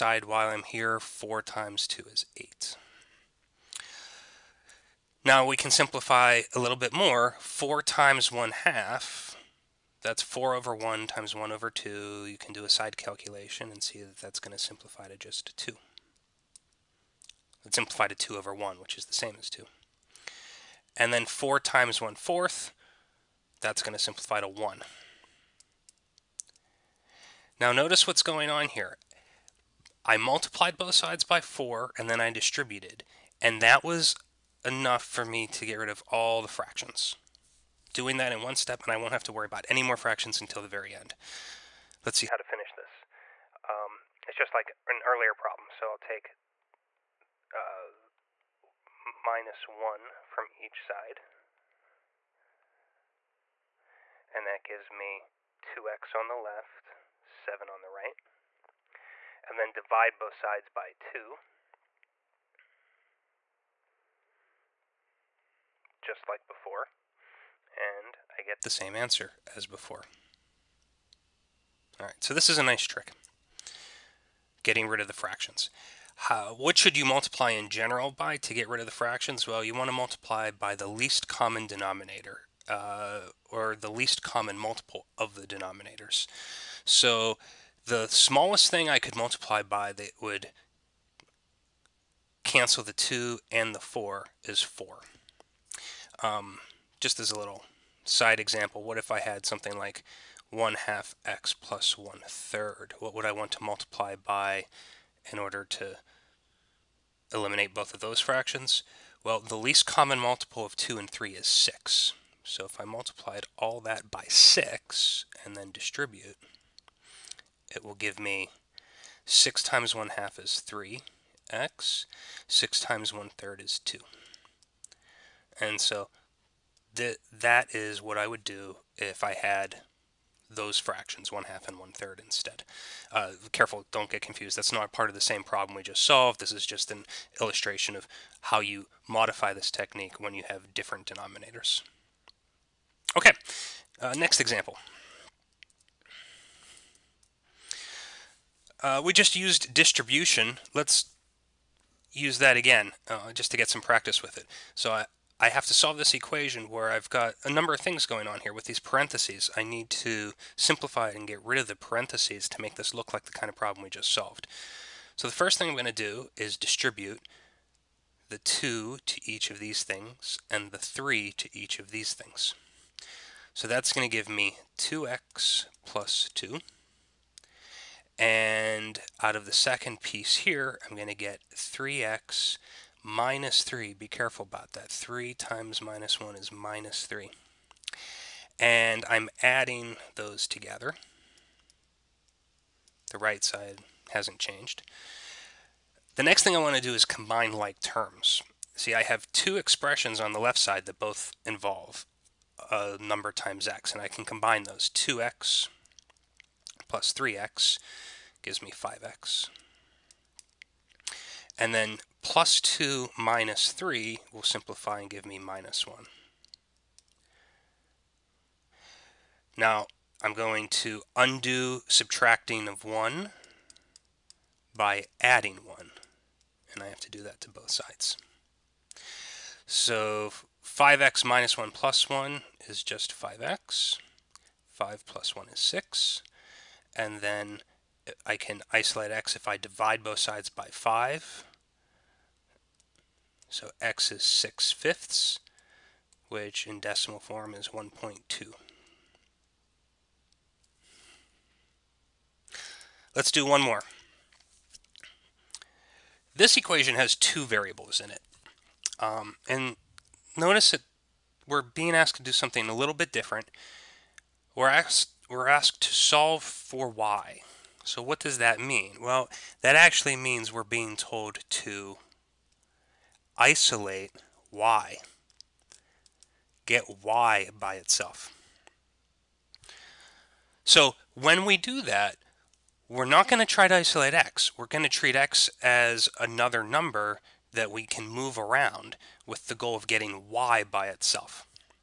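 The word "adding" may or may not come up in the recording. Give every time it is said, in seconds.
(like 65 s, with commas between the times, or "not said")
189 s, 225 s.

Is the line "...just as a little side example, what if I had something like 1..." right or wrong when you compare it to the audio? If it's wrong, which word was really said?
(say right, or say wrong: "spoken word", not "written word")
right.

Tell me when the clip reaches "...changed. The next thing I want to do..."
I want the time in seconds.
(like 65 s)
194 s.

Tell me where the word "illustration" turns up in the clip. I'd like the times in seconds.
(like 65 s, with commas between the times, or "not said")
137 s.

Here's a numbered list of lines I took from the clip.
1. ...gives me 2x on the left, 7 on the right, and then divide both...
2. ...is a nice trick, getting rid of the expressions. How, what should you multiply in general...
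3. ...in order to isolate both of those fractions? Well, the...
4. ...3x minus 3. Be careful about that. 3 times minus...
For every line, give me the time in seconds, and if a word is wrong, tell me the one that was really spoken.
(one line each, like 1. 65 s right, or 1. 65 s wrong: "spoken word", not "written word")
1. 54 s right
2. 72 s wrong: "fractions", not "expressions"
3. 105 s wrong: "eliminate", not "isolate"
4. 181 s right.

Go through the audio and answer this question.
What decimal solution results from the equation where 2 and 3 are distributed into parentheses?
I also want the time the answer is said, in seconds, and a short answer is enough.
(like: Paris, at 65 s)
1.2, at 247 s.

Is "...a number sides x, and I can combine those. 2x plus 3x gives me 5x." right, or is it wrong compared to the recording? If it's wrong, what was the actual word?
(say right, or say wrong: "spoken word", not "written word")
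wrong: "times", not "sides".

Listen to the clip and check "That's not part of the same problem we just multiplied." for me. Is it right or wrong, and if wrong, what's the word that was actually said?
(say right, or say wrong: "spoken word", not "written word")
wrong: "solved", not "multiplied".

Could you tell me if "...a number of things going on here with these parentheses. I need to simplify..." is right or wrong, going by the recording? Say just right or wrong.
right.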